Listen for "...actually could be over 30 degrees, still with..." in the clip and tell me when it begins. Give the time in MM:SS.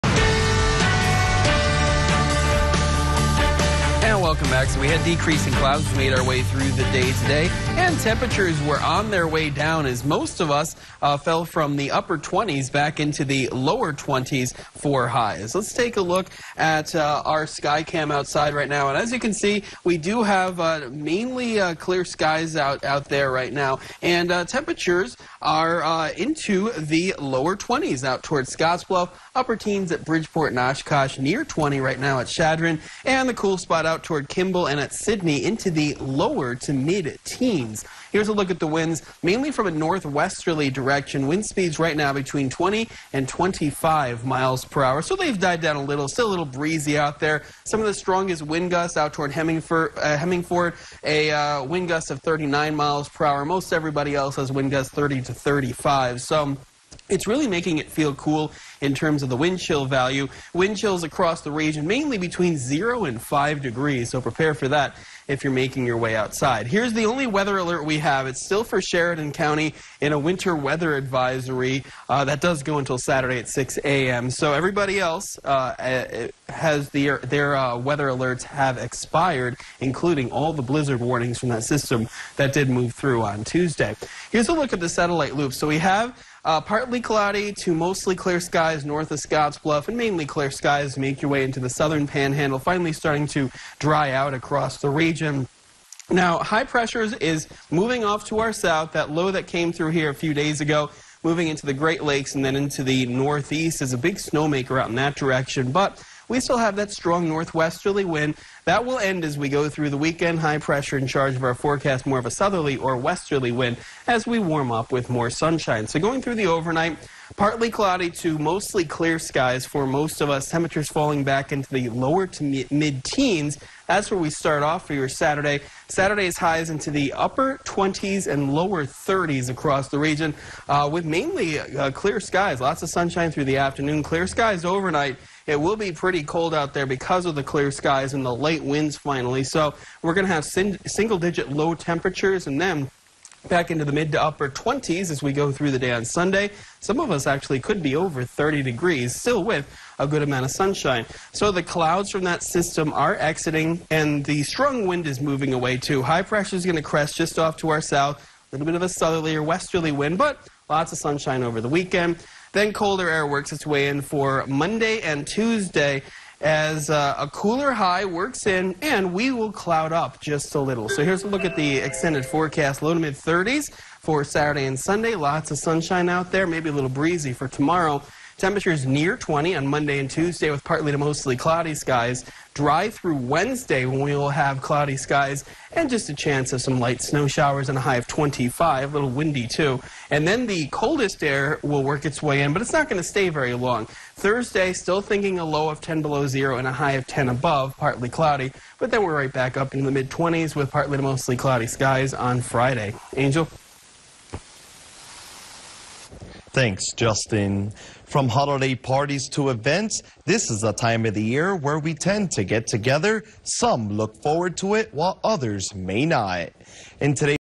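02:27.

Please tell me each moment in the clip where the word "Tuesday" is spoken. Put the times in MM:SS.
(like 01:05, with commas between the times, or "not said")
01:23, 02:45, 03:00.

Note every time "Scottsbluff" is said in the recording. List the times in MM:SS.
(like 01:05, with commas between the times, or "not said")
00:28, 01:29.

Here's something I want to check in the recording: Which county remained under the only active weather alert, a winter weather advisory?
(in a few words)
Sheridan County.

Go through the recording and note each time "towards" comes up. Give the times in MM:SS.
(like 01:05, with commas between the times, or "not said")
00:28, 00:34, 00:49.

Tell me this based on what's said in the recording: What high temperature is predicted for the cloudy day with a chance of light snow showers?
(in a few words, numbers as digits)
25.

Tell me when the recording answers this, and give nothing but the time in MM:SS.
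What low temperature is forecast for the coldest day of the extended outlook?
03:15.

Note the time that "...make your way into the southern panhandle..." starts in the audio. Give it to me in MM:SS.
01:30.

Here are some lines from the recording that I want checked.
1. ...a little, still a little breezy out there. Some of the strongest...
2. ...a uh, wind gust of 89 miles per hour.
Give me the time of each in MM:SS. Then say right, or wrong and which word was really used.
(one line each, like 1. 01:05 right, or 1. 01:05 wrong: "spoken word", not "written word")
1. 00:45 right
2. 00:51 wrong: "39", not "89".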